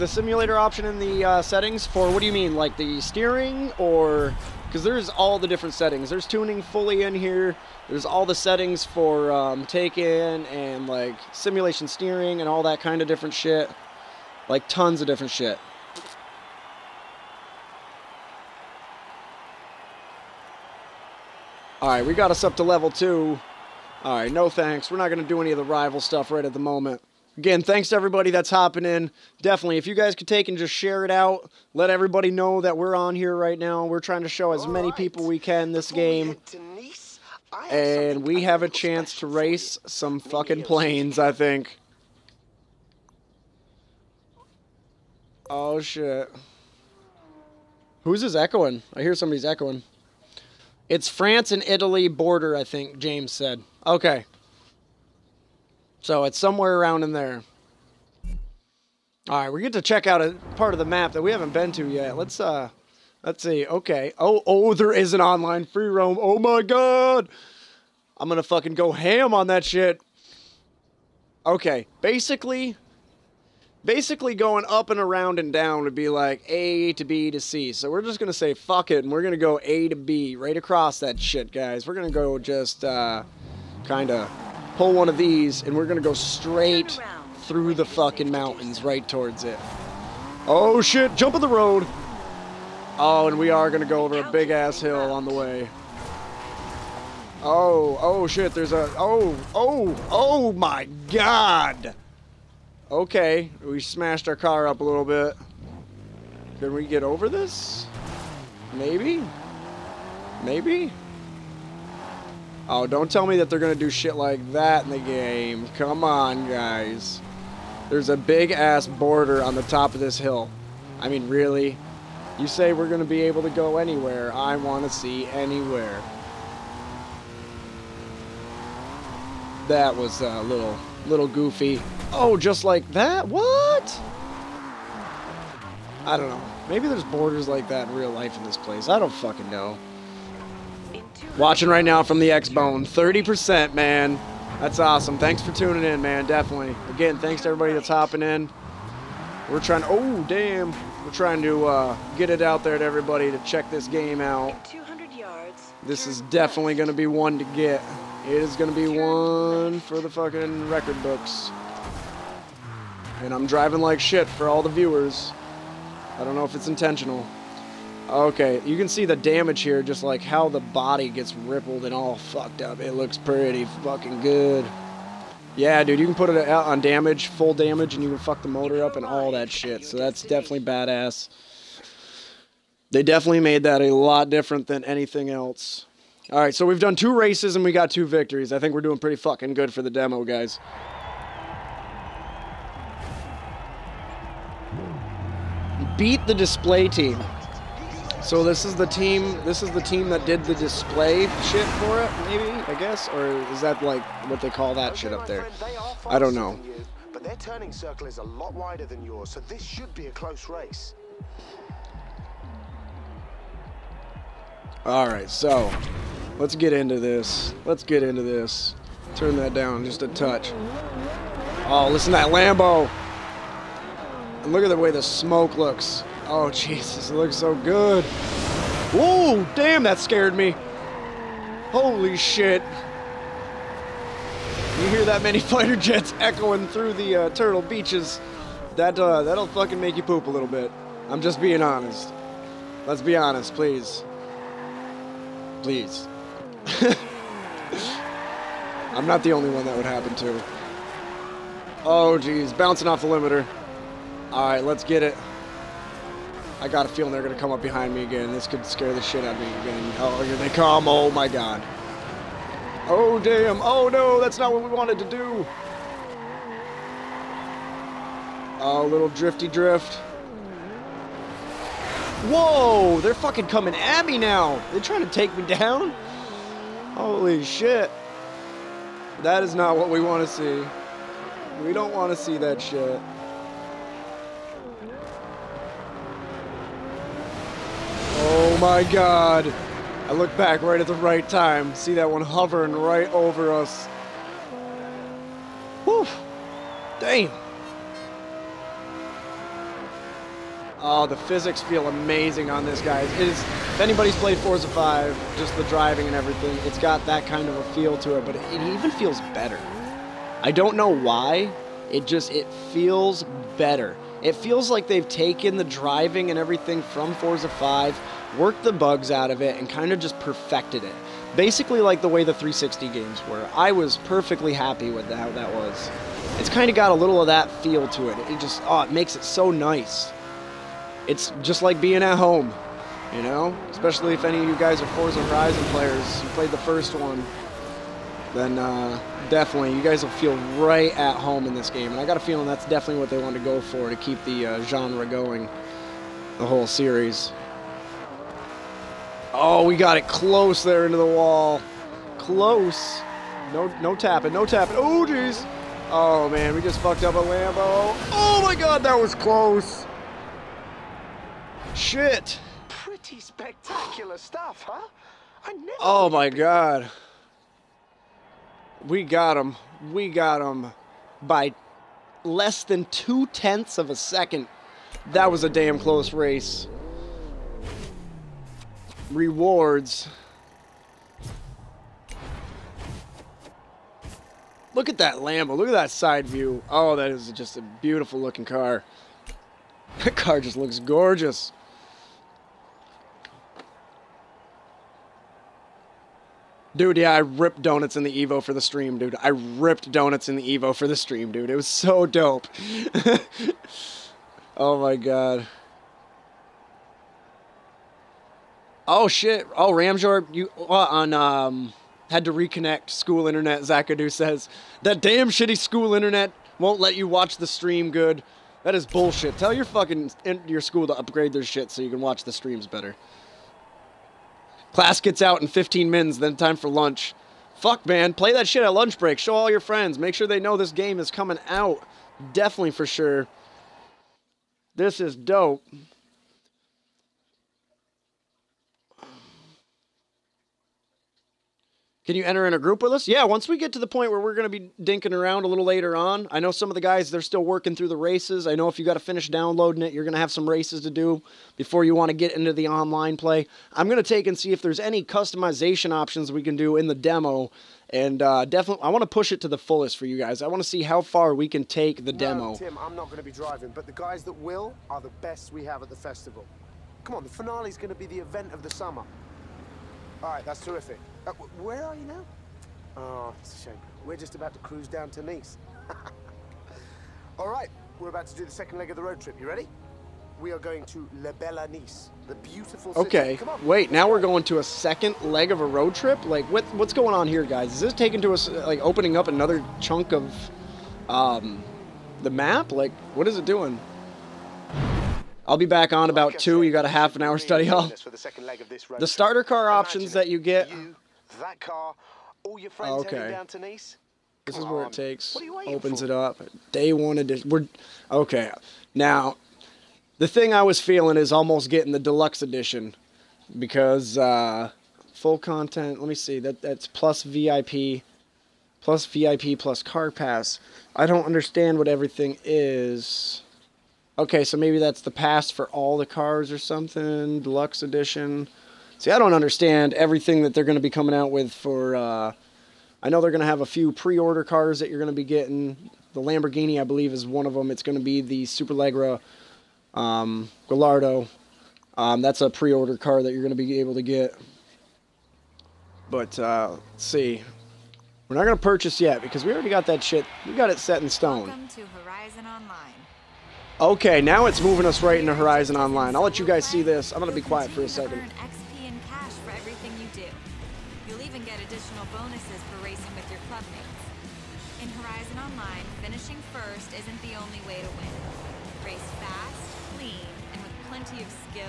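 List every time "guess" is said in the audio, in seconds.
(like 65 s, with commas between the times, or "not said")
202 s.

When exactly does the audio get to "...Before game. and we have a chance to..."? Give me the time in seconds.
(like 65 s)
35 s.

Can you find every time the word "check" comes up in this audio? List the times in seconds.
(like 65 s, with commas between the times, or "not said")
59 s, 153 s.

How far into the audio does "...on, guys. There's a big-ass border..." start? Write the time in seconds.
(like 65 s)
116 s.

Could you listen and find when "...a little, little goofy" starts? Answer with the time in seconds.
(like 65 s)
130 s.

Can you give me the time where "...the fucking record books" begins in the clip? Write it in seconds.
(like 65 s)
159 s.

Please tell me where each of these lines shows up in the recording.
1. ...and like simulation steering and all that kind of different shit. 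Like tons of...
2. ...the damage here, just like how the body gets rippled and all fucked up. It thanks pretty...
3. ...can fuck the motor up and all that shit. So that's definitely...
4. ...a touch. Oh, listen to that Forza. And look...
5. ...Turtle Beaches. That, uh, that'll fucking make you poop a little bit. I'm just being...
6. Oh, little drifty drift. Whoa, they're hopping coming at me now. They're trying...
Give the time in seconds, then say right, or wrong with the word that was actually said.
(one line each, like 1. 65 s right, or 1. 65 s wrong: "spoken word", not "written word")
1. 10 s right
2. 169 s wrong: "looks", not "thanks"
3. 178 s right
4. 220 s wrong: "Lambo", not "Forza"
5. 237 s right
6. 268 s wrong: "fucking", not "hopping".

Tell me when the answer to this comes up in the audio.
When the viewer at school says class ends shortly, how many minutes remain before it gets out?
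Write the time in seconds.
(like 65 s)
425 s.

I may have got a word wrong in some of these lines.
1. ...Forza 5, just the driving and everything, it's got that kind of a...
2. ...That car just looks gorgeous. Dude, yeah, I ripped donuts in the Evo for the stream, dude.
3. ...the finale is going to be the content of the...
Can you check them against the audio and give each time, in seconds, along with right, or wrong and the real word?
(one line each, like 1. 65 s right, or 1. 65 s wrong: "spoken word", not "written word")
1. 304 s right
2. 390 s right
3. 467 s wrong: "event", not "content".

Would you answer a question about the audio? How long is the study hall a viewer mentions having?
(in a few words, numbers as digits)
half an hour.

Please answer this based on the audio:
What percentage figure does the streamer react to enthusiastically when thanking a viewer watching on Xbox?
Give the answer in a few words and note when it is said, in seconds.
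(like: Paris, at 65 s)
30%, at 142 s.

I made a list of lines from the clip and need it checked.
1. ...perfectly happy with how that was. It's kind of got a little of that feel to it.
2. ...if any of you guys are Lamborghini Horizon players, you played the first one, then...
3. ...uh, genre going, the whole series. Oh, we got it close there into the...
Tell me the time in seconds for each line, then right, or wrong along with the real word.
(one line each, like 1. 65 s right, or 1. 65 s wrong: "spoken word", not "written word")
1. 323 s right
2. 334 s wrong: "Forza", not "Lamborghini"
3. 344 s right.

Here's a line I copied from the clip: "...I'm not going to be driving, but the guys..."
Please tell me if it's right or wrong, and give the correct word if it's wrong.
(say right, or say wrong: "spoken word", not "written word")
right.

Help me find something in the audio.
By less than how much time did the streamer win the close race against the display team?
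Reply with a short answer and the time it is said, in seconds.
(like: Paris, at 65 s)
two-tenths of a second, at 372 s.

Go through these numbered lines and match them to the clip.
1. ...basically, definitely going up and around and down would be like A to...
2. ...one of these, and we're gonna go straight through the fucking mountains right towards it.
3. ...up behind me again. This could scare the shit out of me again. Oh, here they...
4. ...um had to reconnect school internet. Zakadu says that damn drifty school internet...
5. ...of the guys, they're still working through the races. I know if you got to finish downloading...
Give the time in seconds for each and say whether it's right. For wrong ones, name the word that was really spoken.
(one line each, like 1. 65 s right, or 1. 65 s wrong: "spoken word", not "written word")
1. 72 s wrong: "basically", not "definitely"
2. 84 s right
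3. 257 s right
4. 411 s wrong: "shitty", not "drifty"
5. 446 s right.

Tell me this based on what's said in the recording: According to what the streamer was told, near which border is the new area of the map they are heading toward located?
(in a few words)
France and Italy border.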